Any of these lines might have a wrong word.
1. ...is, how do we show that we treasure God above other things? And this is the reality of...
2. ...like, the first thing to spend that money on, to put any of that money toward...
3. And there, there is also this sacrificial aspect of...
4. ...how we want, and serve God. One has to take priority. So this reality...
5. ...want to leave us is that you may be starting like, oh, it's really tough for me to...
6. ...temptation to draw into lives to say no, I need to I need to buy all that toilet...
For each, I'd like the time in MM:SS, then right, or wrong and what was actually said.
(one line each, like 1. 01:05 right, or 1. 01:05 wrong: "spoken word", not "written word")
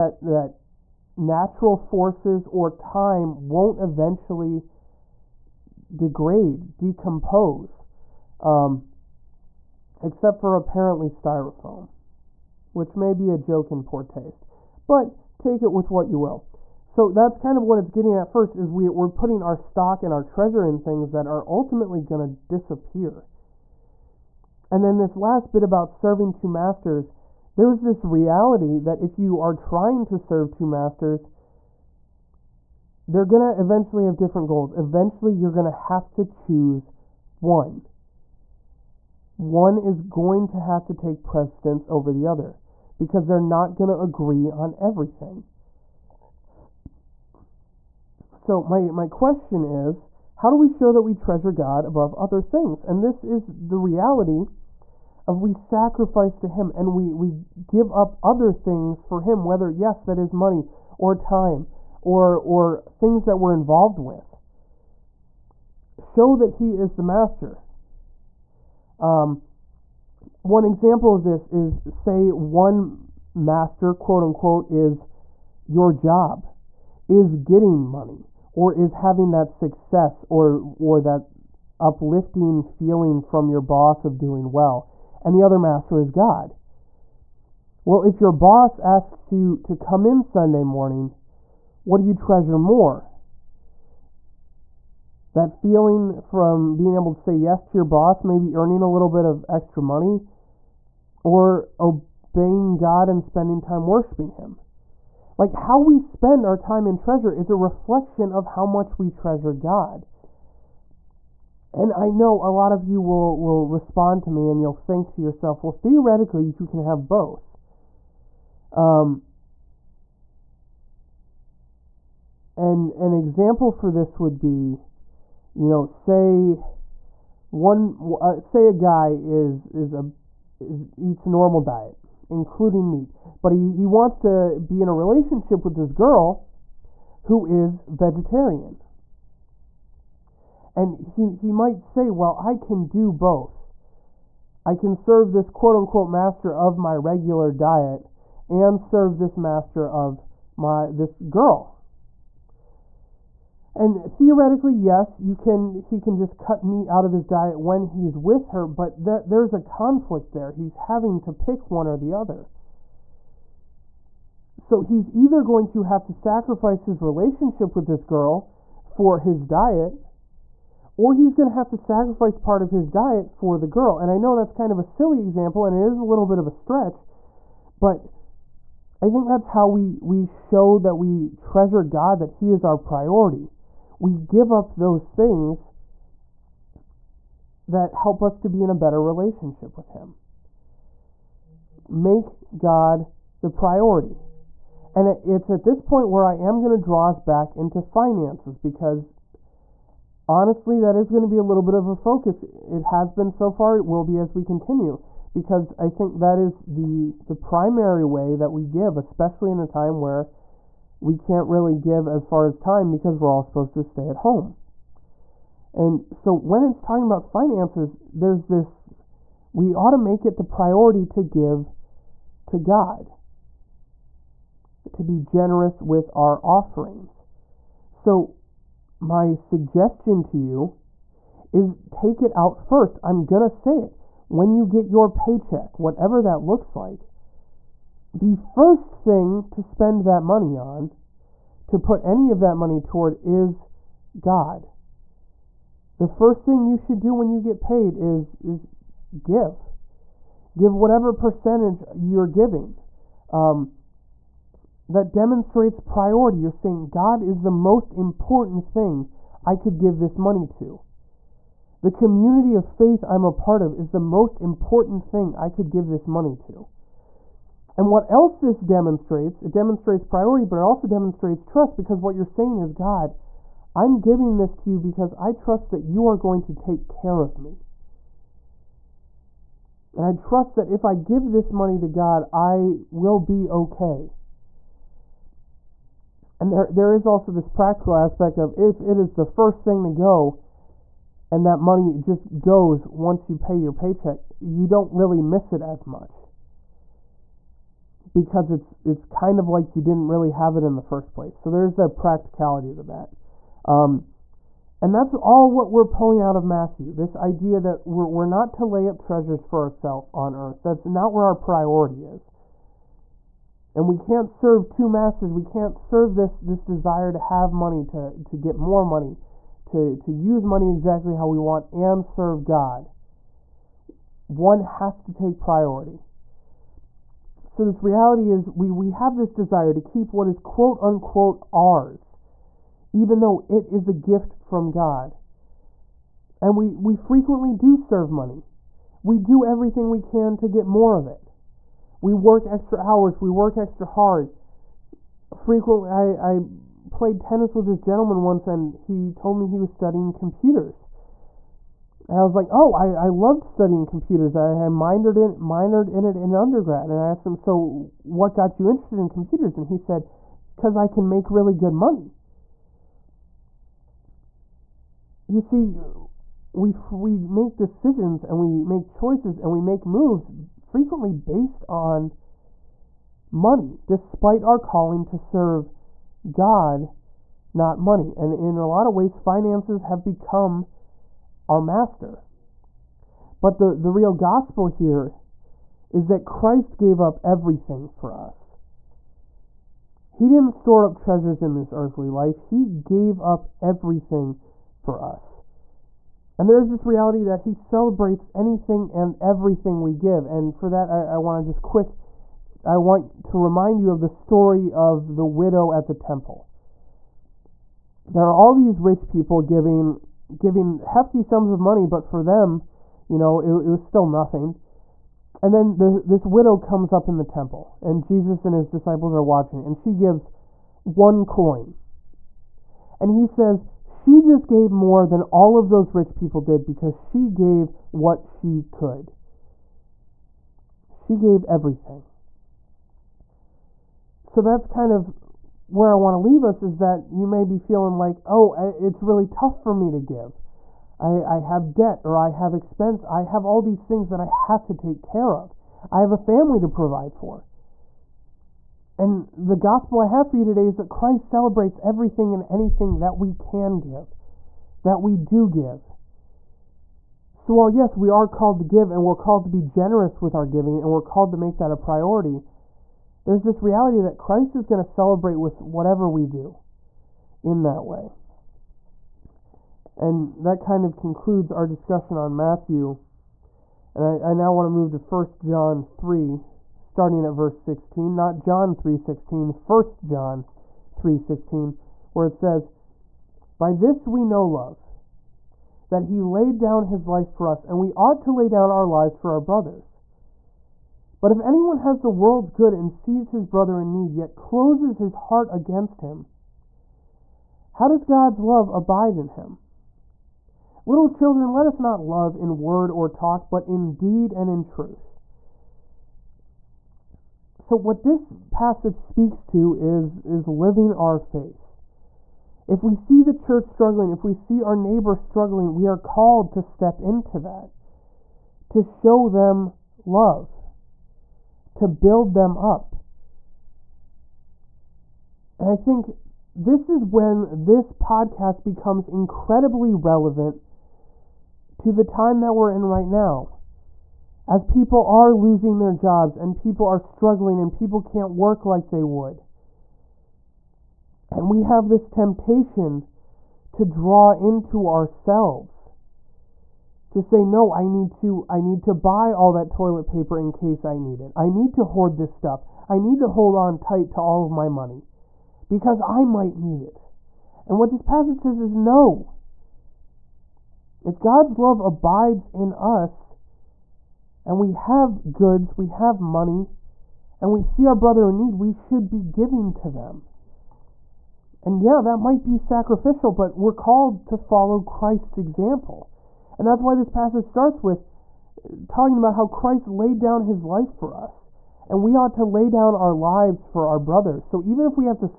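1. 00:49 right
2. 03:56 right
3. 04:46 wrong: "practical", not "sacrificial"
4. 05:21 right
5. 07:15 wrong: "feeling", not "starting"
6. 09:02 wrong: "ourselves", not "lives".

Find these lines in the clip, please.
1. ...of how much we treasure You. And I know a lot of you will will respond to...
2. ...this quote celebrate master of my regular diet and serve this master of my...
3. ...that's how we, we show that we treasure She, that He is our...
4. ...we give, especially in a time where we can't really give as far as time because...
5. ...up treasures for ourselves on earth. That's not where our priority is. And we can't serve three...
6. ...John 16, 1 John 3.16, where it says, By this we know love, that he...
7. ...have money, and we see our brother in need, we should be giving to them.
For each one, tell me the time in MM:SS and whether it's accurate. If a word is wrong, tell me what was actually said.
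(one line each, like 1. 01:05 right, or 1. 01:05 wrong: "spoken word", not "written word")
1. 01:48 wrong: "God", not "You"
2. 02:25 wrong: "unquote", not "celebrate"
3. 02:59 wrong: "God", not "She"
4. 03:28 right
5. 05:08 wrong: "two", not "three"
6. 07:58 right
7. 09:25 right.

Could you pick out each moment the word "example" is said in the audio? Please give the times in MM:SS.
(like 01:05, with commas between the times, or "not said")
01:10, 02:03, 02:55, 09:35.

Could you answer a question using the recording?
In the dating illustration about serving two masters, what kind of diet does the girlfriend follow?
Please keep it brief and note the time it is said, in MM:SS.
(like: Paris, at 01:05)
Vegetarian, at 02:17.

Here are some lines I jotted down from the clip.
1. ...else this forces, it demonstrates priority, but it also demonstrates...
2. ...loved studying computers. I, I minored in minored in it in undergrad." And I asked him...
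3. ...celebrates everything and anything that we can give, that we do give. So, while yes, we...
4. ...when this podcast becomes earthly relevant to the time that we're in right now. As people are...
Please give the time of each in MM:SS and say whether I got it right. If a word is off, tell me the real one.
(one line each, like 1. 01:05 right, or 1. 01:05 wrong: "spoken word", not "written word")
1. 04:28 wrong: "demonstrates", not "forces"
2. 05:53 right
3. 07:31 right
4. 08:47 wrong: "incredibly", not "earthly".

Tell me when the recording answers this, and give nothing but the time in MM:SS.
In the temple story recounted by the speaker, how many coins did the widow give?
07:00.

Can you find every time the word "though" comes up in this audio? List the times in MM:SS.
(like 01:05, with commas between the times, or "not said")
05:33.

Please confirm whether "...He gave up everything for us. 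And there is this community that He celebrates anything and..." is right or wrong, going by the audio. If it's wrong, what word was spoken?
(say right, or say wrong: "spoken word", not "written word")
wrong: "reality", not "community".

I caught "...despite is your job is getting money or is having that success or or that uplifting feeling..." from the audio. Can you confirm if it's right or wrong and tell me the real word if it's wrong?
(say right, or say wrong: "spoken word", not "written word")
wrong: "unquote", not "despite".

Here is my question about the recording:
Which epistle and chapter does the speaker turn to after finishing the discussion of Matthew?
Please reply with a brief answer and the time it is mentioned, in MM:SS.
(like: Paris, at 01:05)
1 John 3, at 07:54.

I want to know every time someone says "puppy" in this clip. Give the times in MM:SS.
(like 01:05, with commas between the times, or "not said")
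not said.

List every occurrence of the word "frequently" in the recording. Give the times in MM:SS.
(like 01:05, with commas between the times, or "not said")
05:36, 05:45, 06:10.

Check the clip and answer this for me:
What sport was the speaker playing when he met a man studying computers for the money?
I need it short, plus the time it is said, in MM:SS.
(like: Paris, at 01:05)
Tennis, at 05:47.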